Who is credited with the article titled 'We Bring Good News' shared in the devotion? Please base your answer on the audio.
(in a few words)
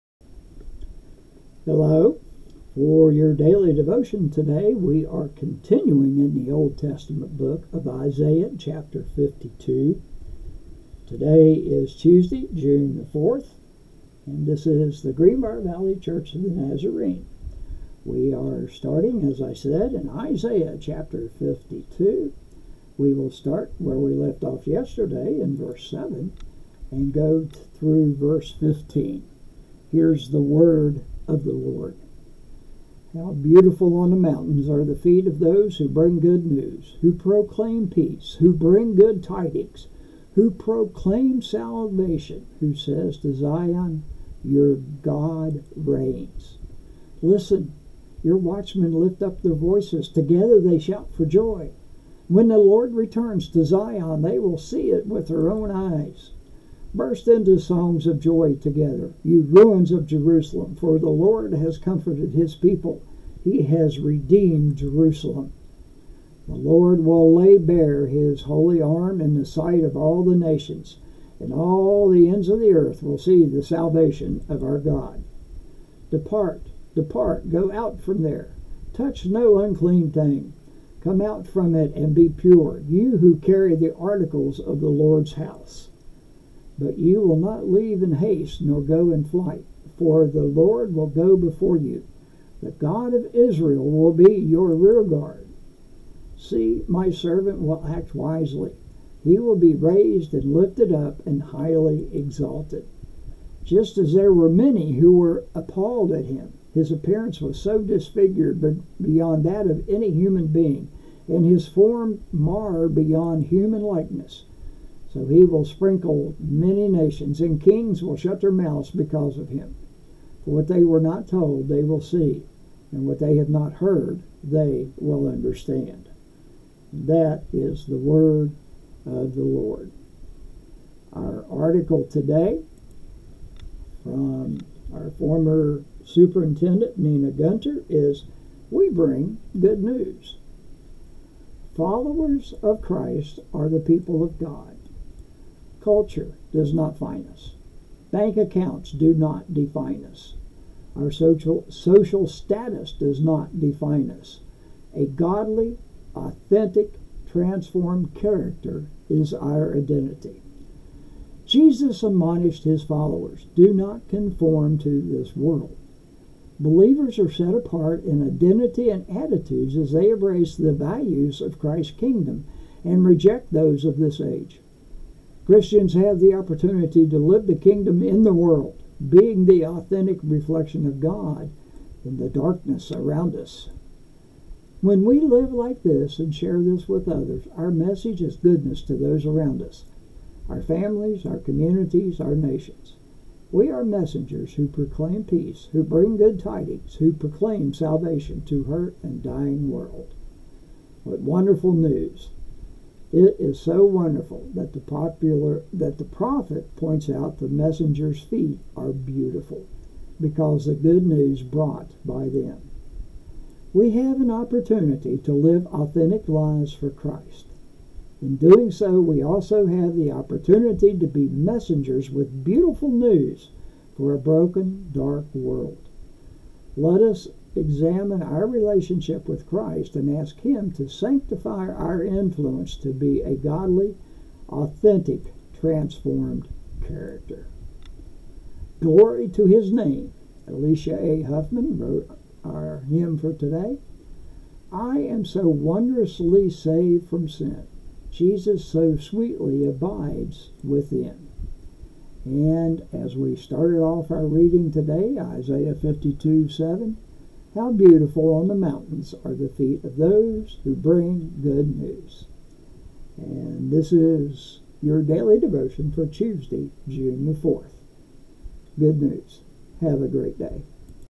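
Nina Gunter.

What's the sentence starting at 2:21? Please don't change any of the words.
Followers of Christ are the people of God.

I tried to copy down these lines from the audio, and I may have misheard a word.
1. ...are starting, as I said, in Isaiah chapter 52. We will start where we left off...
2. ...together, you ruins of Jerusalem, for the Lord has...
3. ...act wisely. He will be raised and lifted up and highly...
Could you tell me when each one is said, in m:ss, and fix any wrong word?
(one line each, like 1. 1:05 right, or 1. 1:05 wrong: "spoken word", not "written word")
1. 0:18 right
2. 0:58 right
3. 1:37 right.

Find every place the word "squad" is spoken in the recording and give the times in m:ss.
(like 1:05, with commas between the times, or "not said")
not said.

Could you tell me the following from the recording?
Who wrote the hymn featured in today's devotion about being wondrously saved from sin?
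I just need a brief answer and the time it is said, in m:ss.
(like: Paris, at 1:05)
Elisha A. Hoffman, at 4:00.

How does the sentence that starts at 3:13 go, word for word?
We are messengers who proclaim peace, who bring good tidings, who proclaim salvation to hurt and dying world.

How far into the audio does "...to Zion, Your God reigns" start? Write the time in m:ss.
0:43.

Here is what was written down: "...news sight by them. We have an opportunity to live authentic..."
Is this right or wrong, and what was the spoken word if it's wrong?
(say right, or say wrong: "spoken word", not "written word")
wrong: "brought", not "sight".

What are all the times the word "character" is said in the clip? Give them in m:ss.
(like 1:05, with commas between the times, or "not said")
2:38, 3:56.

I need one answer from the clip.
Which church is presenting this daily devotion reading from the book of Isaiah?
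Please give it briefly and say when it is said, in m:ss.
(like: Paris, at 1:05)
Greenbar Valley Church of the Nazarene, at 0:15.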